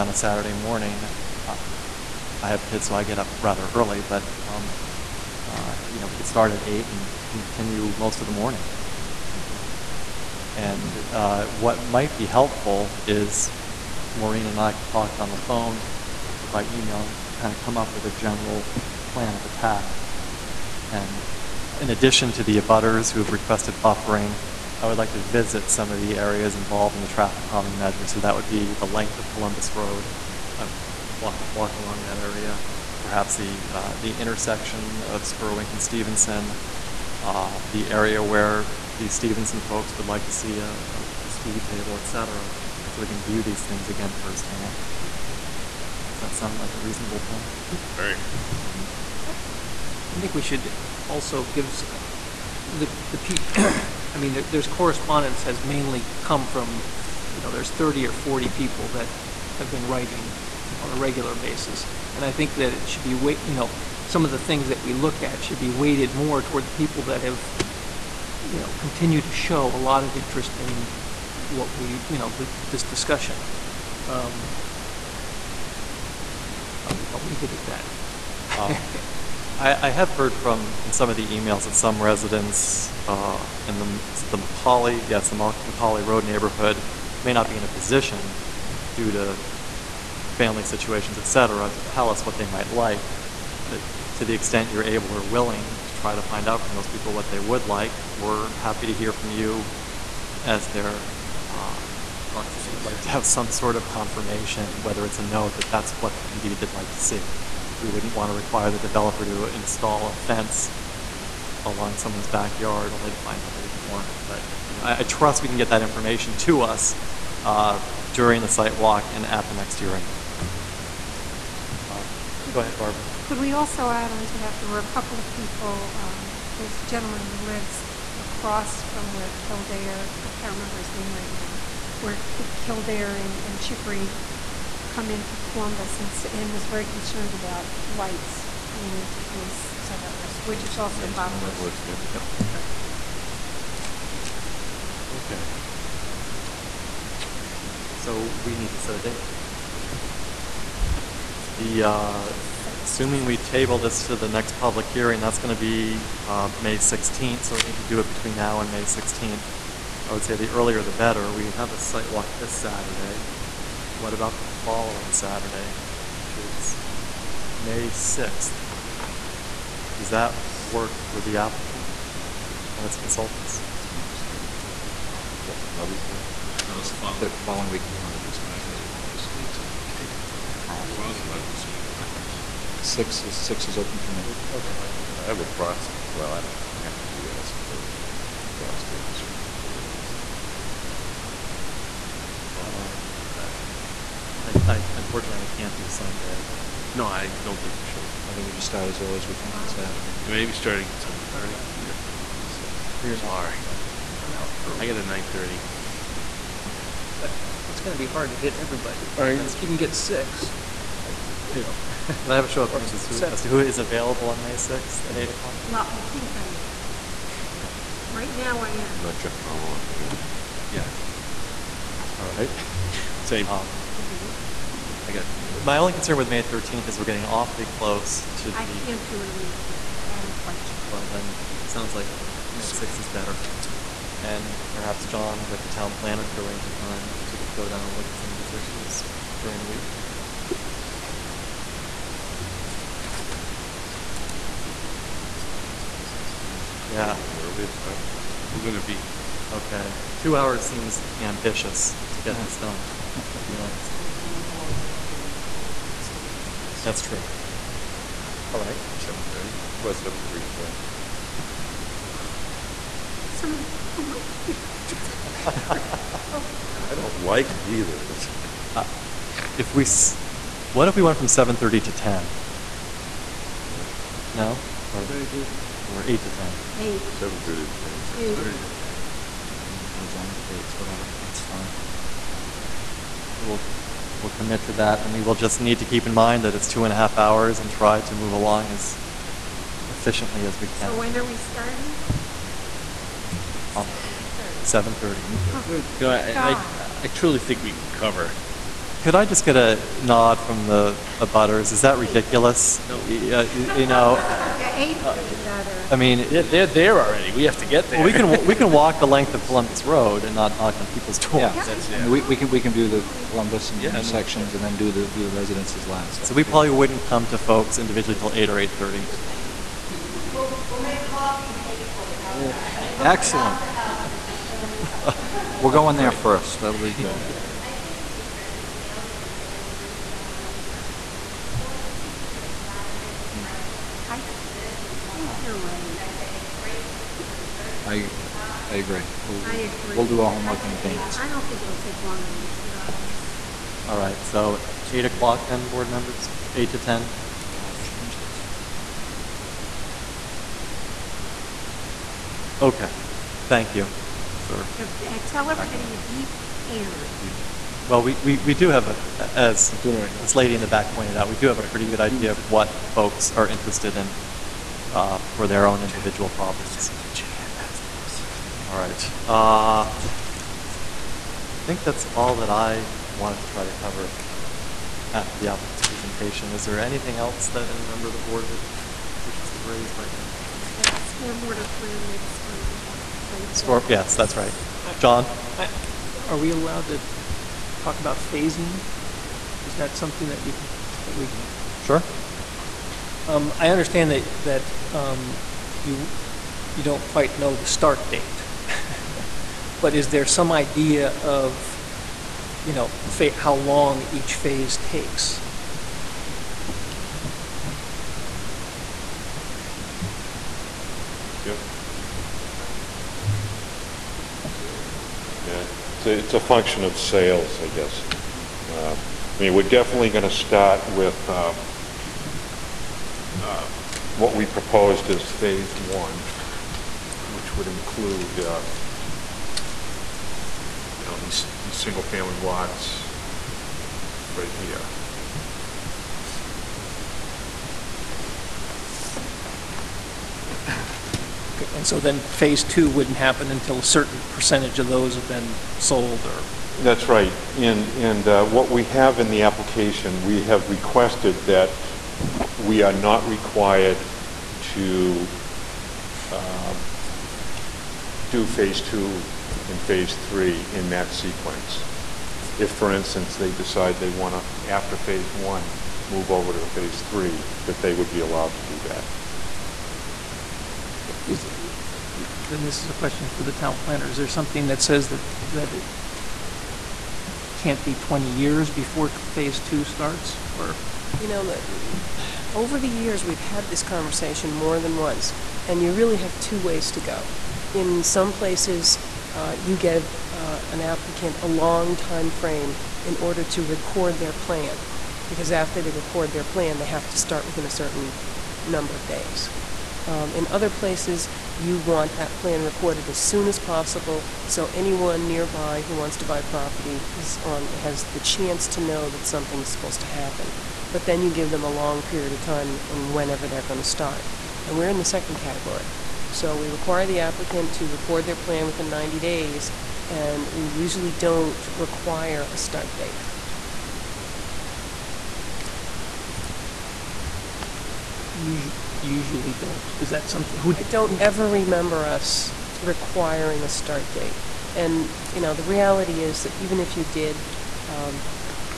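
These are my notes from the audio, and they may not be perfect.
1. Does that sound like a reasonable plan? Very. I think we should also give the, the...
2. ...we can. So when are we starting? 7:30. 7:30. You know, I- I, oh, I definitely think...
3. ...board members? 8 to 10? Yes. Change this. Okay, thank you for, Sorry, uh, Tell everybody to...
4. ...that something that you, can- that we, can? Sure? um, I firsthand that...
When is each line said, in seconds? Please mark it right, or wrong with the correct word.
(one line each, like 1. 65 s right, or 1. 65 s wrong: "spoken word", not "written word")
1. 45 s right
2. 290 s wrong: "truly", not "definitely"
3. 345 s wrong: "Yeah", not "Sorry"
4. 389 s wrong: "understand", not "firsthand".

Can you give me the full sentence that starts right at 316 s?
So we probably wouldn't come to folks individually till 8 or 8:30.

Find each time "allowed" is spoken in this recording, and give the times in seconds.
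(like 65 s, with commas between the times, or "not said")
386 s, 468 s.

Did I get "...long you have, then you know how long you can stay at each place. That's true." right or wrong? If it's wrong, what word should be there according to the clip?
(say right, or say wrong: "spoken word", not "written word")
right.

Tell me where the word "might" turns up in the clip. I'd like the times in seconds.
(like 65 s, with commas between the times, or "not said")
11 s, 92 s, 264 s.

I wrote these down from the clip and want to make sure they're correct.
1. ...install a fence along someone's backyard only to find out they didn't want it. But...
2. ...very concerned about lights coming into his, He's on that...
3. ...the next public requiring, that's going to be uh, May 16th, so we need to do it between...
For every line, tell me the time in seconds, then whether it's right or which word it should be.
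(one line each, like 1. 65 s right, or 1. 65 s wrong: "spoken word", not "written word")
1. 109 s right
2. 136 s right
3. 154 s wrong: "hearing", not "requiring".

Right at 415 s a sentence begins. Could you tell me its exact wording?
Yeah, it's a, it's a function of sales, I guess.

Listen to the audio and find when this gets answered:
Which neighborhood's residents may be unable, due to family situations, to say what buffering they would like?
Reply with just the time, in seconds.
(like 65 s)
85 s.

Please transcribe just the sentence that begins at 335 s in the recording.
And I say, great, you've heard me.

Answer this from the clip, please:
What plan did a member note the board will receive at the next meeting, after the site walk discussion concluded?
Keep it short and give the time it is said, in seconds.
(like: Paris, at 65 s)
stormwater plan, at 381 s.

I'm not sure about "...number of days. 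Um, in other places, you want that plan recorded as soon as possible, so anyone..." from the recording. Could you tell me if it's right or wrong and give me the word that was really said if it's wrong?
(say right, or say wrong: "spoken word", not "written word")
right.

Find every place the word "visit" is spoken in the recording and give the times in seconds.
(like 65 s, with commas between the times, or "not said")
25 s, 245 s.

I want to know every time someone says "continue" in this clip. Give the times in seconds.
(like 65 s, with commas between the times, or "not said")
7 s, 68 s.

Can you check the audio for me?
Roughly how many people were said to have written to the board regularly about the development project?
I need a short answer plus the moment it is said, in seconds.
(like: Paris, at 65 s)
30 or 40, at 57 s.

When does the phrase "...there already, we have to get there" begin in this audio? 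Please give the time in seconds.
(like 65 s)
306 s.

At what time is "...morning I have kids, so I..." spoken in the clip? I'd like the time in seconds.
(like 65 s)
0 s.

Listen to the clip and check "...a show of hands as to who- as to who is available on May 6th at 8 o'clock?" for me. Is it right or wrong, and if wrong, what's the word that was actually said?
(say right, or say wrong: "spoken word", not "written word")
right.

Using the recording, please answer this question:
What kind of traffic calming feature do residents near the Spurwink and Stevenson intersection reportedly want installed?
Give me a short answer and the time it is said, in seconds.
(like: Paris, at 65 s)
speed table, at 41 s.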